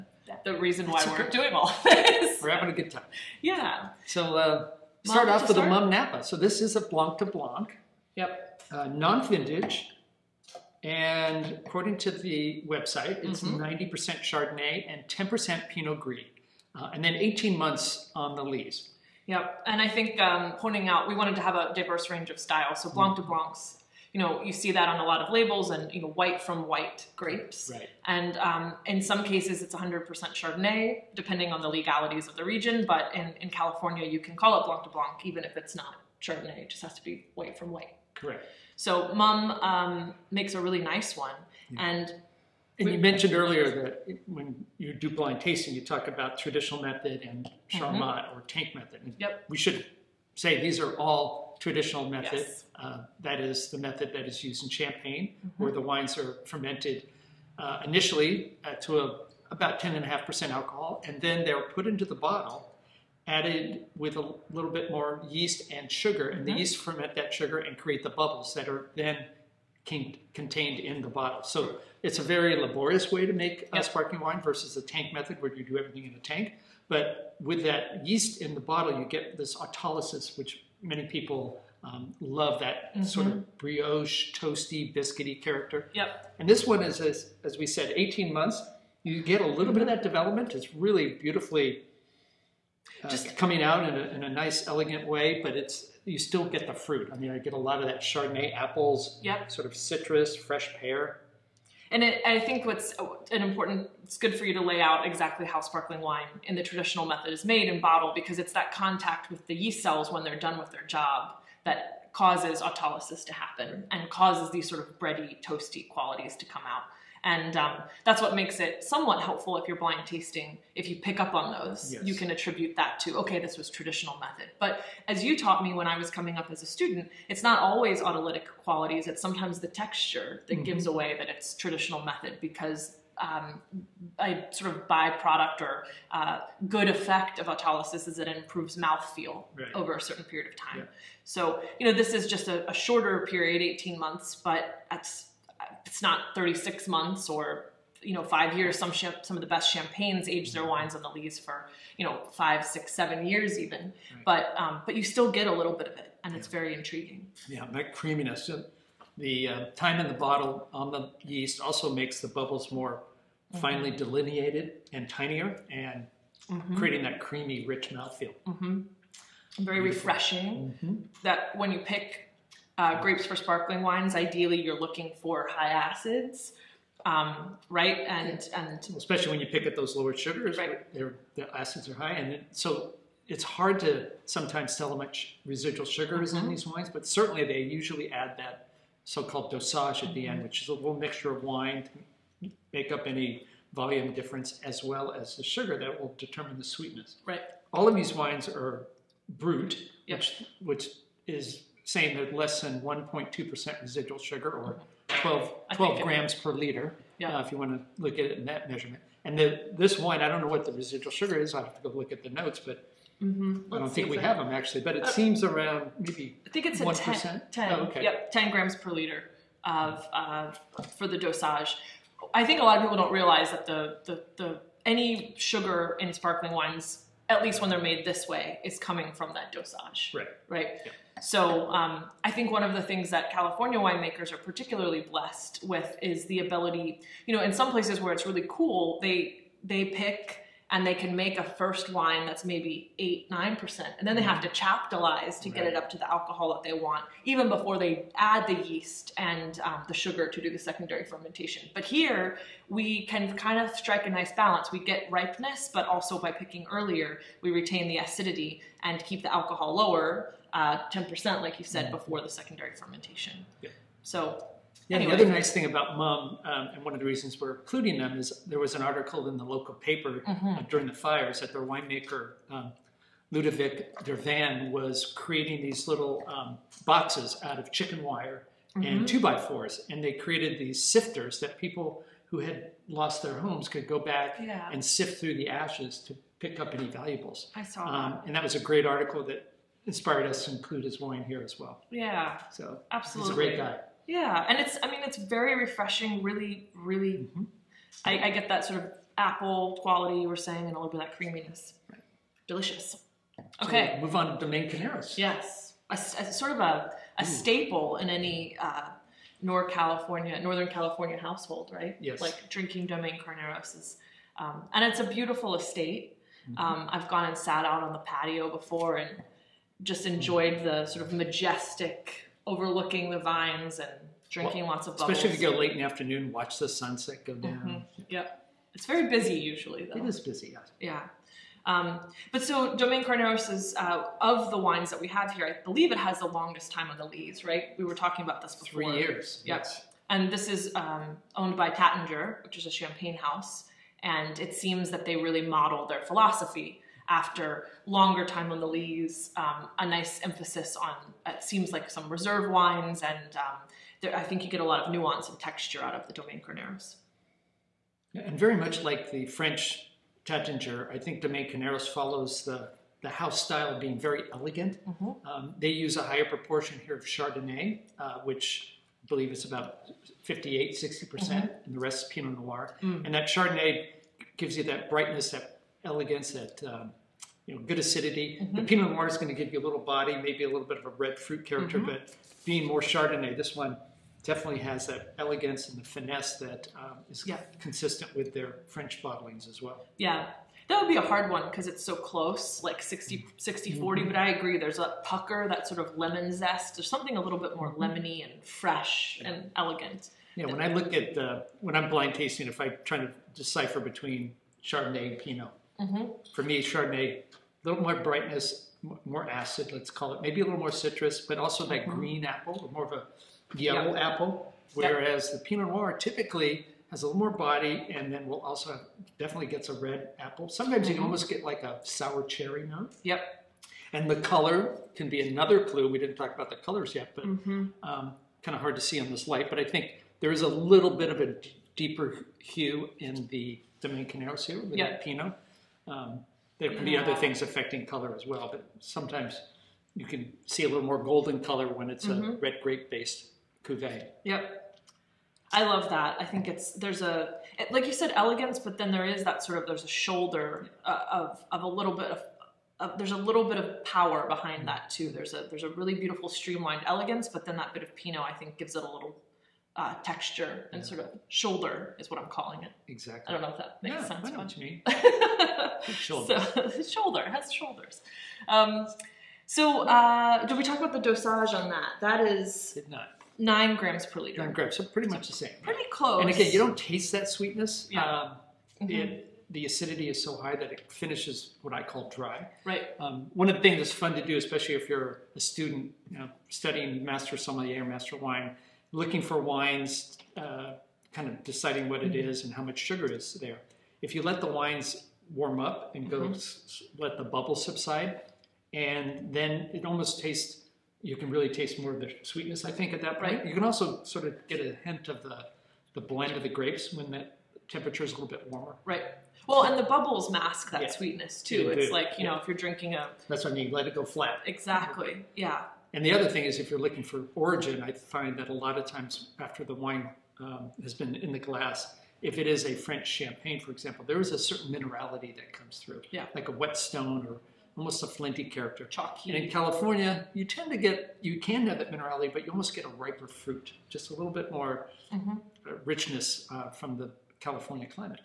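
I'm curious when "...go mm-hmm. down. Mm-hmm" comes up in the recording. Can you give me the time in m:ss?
5:27.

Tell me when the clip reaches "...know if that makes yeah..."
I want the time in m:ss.
7:43.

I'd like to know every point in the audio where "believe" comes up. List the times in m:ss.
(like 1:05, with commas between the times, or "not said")
5:35, 6:09.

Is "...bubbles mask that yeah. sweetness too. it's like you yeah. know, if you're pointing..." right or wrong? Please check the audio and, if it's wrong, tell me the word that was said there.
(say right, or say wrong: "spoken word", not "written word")
wrong: "drinking", not "pointing".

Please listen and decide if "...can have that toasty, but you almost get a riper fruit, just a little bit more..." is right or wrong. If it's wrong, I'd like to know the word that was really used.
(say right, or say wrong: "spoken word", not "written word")
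wrong: "minerality", not "toasty".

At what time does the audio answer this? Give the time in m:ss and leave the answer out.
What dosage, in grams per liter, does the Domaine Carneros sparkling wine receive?
7:53.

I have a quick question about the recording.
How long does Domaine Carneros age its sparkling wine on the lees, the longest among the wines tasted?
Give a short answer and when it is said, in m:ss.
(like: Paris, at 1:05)
3 years, at 5:38.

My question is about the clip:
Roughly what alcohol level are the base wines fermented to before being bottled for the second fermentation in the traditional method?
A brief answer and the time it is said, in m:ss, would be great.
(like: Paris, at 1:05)
10.5%, at 0:59.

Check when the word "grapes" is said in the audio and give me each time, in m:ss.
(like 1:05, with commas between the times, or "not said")
0:27, 2:53, 7:22, 8:26.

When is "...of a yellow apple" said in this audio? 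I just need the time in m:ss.
6:52.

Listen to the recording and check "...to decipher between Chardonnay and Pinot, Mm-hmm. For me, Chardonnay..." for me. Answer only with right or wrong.
right.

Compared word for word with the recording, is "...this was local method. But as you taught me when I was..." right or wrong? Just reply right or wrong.
wrong.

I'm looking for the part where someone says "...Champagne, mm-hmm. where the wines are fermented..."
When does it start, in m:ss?
0:54.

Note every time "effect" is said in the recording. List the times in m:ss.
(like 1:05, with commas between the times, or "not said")
2:16.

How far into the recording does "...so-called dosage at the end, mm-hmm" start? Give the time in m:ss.
3:09.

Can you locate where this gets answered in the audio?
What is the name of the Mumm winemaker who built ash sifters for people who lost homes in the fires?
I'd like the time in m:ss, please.
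4:33.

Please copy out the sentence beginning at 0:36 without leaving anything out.
It just has to be white from white.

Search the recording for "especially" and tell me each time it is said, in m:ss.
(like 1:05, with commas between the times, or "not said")
2:58, 5:25, 8:04.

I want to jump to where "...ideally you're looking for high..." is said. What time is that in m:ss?
2:54.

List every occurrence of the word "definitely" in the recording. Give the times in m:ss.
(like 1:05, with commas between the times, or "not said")
6:24, 6:59.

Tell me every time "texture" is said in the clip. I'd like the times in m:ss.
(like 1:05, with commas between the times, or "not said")
2:09, 5:55, 7:40.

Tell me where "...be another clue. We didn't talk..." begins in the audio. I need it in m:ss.
7:05.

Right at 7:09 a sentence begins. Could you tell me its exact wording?
But I think there is a little bit of a d- deeper hue in the Domaine Carneros here with that Pinot.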